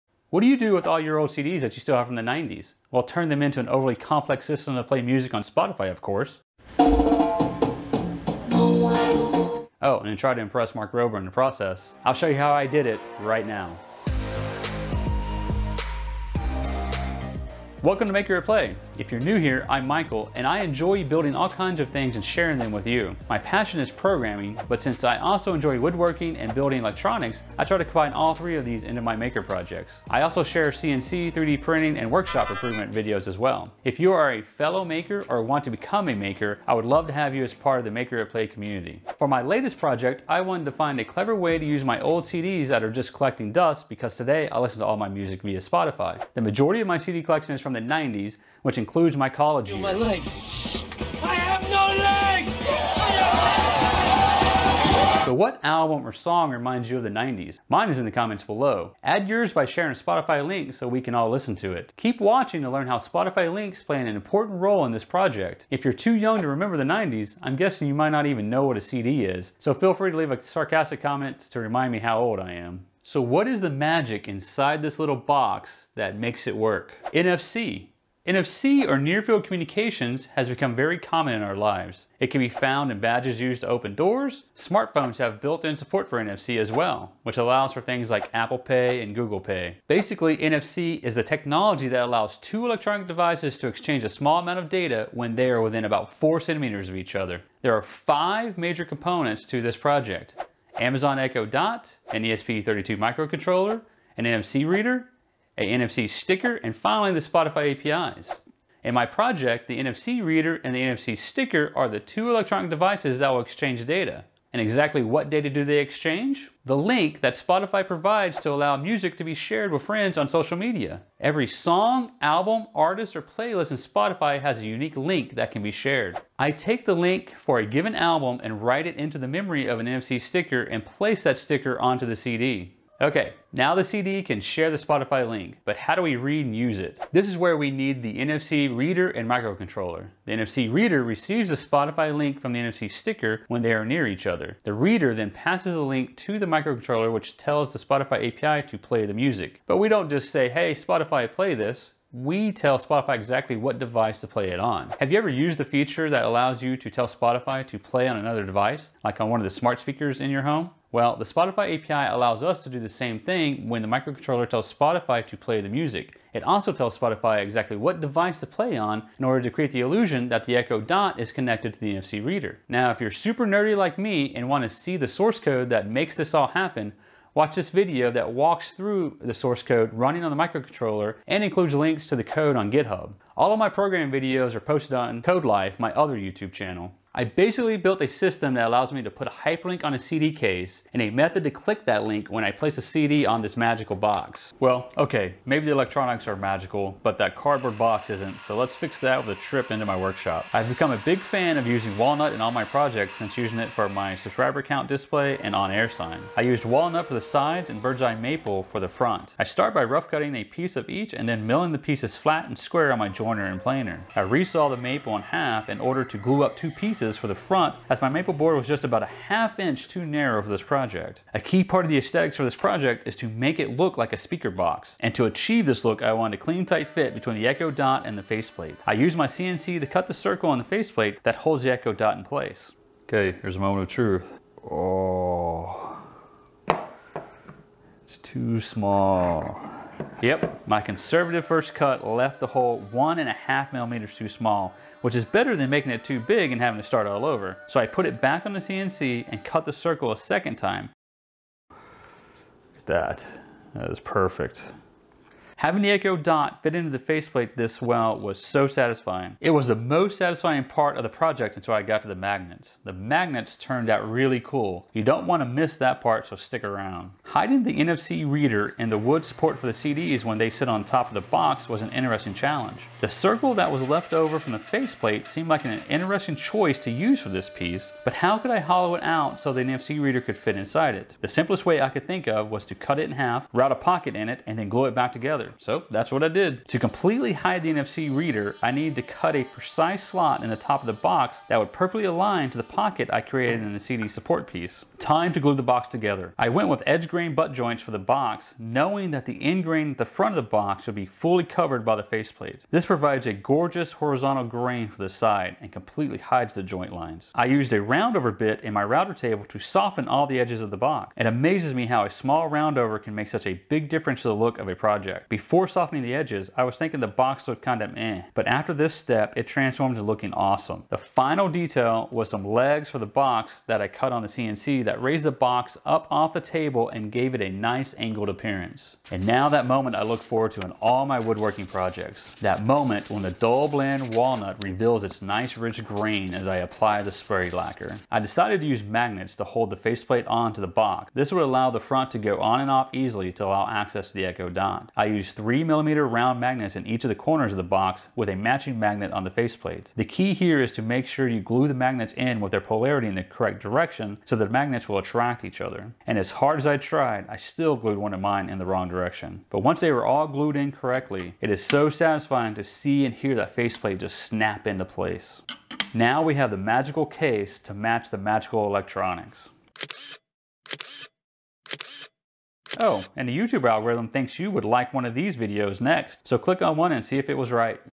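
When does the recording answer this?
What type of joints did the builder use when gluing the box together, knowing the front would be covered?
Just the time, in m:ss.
4:56.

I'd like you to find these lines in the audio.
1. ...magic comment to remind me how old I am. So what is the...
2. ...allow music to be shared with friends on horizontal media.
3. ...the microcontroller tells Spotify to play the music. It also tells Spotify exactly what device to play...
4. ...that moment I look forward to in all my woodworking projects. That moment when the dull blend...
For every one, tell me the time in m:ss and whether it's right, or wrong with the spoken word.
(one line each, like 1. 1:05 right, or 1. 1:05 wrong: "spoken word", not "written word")
1. 1:10 wrong: "sarcastic", not "magic"
2. 1:58 wrong: "social", not "horizontal"
3. 2:43 right
4. 5:29 right.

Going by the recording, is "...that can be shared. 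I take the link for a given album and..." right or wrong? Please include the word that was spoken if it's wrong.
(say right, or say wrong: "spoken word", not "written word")
right.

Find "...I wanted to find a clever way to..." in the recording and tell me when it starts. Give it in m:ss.
0:40.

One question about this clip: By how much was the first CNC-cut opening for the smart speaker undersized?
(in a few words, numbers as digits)
1.5 millimeters.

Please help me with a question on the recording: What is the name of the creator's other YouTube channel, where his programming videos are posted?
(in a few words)
CodeLife.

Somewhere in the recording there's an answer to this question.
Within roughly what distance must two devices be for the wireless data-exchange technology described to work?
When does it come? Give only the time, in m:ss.
1:36.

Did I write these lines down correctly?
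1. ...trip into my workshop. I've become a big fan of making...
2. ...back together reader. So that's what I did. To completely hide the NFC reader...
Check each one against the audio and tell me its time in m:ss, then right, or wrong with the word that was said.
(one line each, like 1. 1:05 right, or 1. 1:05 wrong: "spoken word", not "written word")
1. 3:19 wrong: "using", not "making"
2. 4:44 right.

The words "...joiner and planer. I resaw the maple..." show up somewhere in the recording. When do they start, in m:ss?
3:33.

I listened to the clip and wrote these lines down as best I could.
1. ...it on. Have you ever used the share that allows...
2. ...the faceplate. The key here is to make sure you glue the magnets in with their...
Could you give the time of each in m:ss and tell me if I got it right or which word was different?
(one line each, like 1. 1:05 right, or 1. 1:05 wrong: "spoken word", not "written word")
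1. 2:34 wrong: "feature", not "share"
2. 5:49 right.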